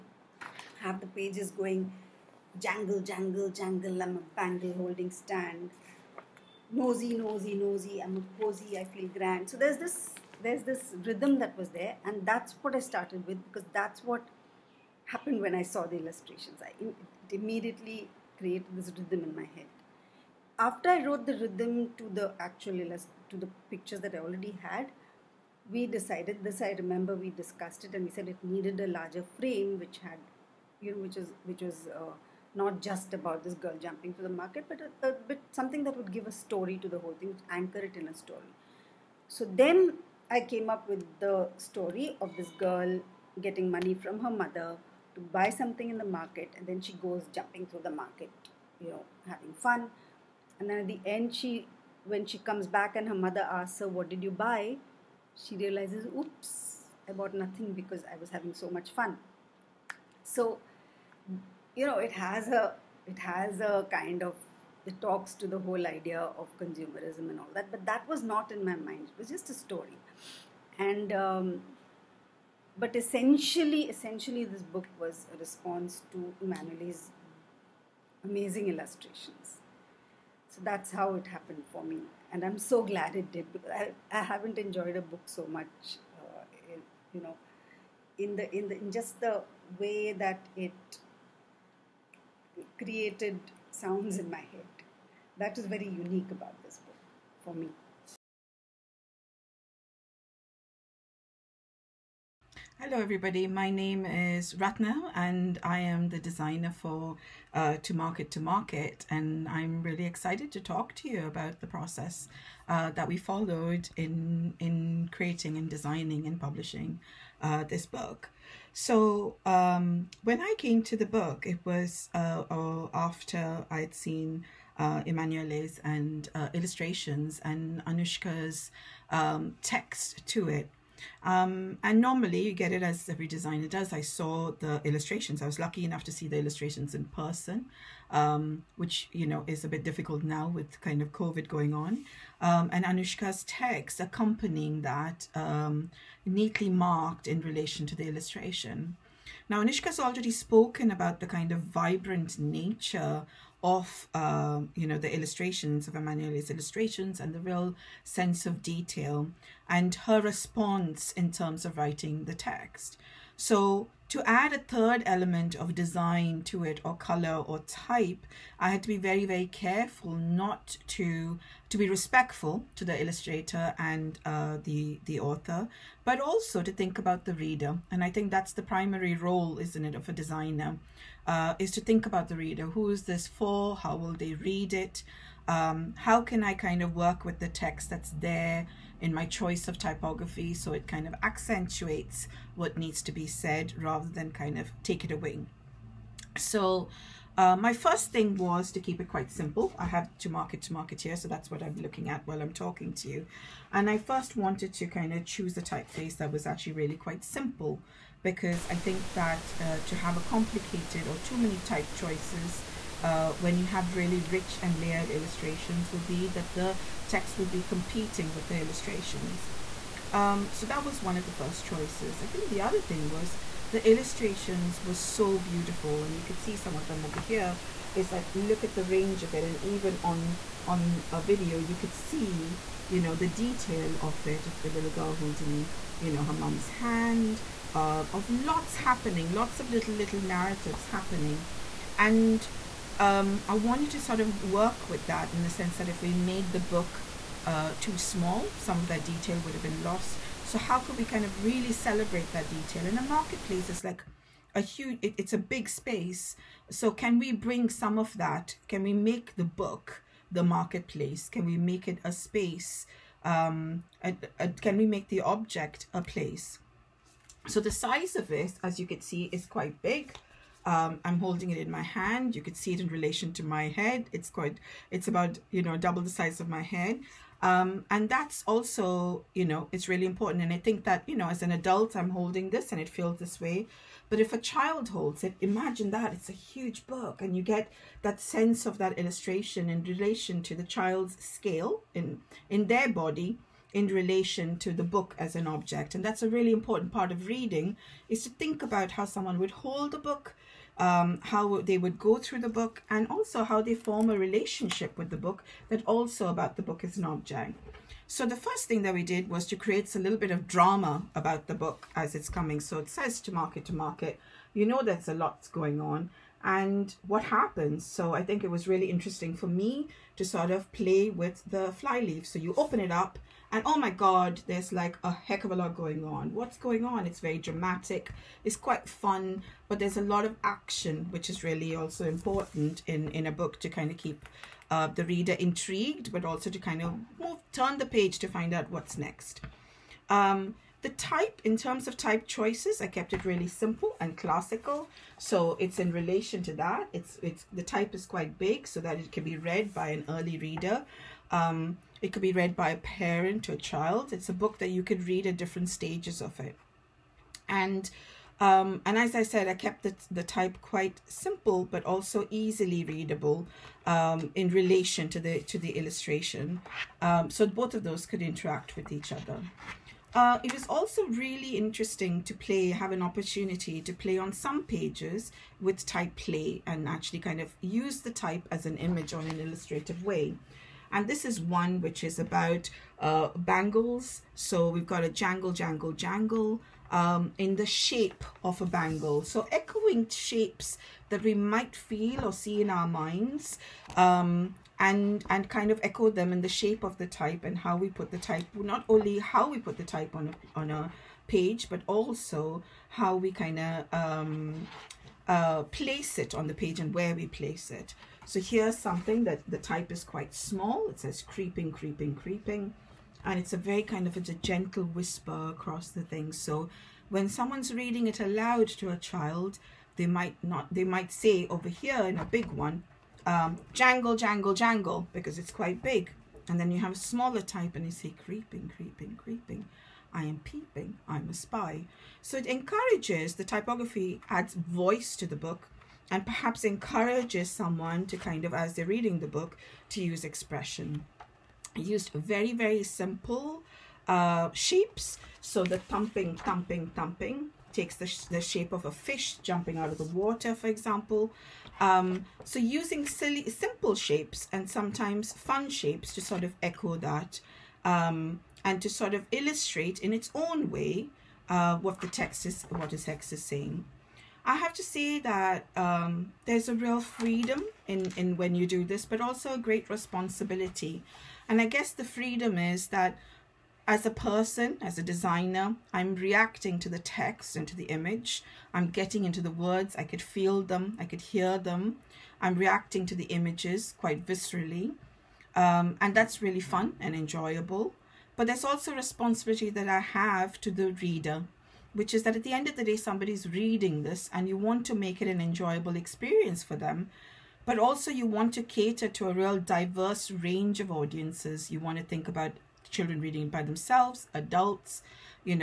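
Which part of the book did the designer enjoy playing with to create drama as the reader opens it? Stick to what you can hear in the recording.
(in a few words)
The fly leaf.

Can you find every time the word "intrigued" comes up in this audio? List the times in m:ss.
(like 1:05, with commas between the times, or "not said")
5:35.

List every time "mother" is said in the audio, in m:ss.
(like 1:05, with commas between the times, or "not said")
0:44, 0:53.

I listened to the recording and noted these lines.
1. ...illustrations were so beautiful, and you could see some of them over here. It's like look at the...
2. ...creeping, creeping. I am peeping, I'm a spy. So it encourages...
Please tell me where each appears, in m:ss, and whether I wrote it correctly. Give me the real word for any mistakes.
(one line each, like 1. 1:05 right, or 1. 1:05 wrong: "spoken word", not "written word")
1. 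3:43 right
2. 7:08 right.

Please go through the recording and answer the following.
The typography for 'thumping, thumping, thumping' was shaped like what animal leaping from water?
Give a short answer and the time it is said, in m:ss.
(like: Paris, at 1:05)
A fish, at 7:28.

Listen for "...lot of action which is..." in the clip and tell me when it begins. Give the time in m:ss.
5:30.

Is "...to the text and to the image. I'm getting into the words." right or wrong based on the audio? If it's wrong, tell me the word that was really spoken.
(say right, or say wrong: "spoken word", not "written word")
right.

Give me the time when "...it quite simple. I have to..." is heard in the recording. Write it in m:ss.
3:18.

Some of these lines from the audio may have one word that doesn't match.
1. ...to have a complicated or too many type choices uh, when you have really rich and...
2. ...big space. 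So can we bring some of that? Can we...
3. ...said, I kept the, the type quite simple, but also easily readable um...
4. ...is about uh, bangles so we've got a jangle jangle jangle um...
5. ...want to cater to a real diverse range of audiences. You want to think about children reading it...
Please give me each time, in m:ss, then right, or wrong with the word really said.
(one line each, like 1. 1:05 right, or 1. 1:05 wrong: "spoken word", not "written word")
1. 3:29 right
2. 4:15 right
3. 5:59 right
4. 6:22 right
5. 8:18 right.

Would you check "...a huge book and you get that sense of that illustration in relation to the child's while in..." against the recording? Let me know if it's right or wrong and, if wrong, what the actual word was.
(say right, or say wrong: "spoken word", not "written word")
wrong: "scale", not "while".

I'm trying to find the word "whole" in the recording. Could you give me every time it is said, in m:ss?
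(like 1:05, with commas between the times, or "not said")
0:36, 1:05.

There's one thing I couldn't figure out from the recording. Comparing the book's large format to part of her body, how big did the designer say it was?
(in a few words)
Double the size of my head.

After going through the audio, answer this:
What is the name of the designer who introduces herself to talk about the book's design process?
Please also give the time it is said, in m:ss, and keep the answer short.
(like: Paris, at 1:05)
Rathna, at 1:44.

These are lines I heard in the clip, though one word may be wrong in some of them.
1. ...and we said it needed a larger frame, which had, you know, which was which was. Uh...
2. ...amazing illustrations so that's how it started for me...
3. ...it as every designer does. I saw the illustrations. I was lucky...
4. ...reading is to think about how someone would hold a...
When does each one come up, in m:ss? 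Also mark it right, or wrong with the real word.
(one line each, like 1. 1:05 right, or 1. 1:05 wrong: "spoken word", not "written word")
1. 0:27 right
2. 1:18 wrong: "happened", not "started"
3. 2:12 right
4. 4:57 right.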